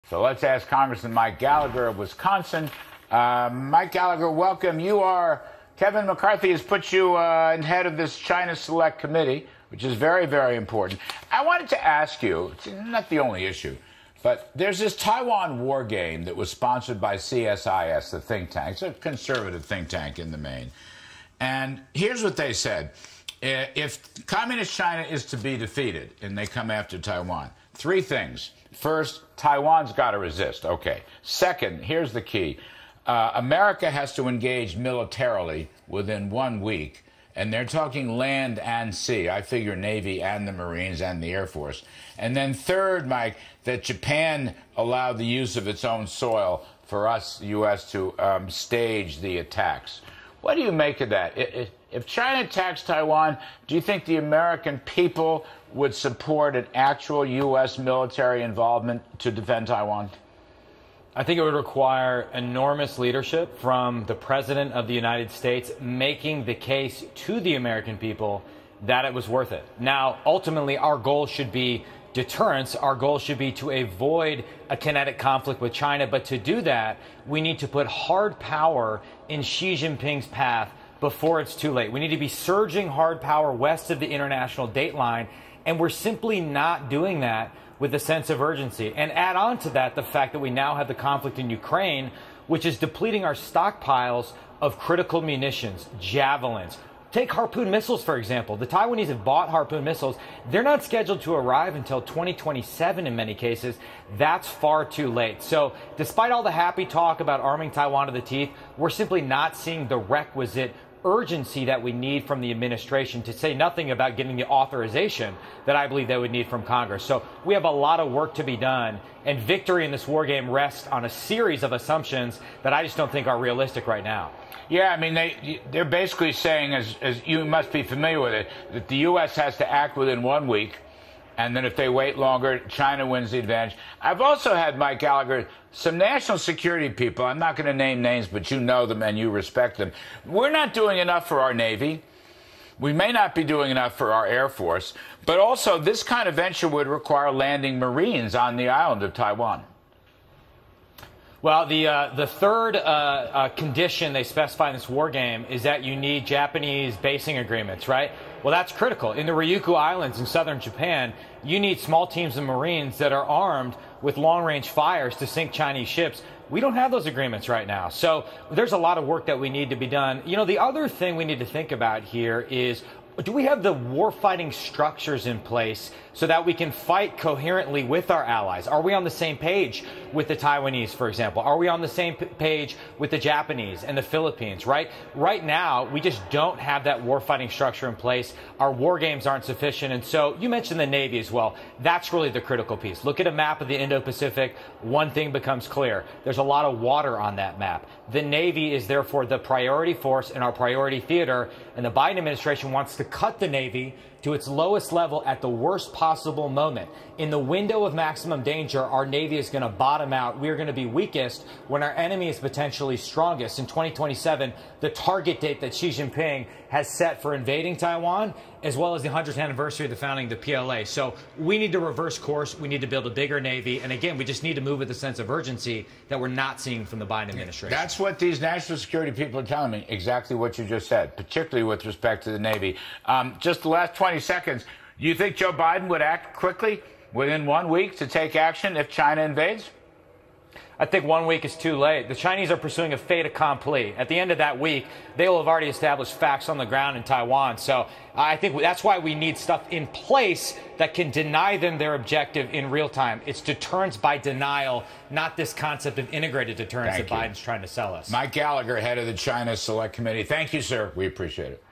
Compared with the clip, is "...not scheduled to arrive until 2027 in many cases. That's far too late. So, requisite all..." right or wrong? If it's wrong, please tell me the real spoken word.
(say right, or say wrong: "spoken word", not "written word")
wrong: "despite", not "requisite".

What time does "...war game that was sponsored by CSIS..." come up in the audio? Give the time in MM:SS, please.
00:15.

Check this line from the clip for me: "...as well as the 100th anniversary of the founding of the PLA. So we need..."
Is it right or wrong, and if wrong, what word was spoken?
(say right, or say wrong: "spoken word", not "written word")
right.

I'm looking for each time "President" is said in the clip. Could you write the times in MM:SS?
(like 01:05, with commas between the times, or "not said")
01:04.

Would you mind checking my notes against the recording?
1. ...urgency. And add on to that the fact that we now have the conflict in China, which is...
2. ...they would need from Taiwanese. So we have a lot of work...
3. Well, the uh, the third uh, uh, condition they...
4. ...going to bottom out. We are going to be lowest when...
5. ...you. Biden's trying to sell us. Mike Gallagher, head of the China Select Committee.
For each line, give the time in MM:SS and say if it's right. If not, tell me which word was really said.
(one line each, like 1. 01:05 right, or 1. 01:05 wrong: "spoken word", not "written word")
1. 01:28 wrong: "Ukraine", not "China"
2. 01:56 wrong: "Congress", not "Taiwanese"
3. 02:31 right
4. 03:29 wrong: "weakest", not "lowest"
5. 04:17 right.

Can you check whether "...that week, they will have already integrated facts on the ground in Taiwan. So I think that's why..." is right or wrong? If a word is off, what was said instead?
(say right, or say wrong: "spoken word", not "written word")
wrong: "established", not "integrated".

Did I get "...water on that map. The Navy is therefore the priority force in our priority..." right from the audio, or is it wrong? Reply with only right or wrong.
right.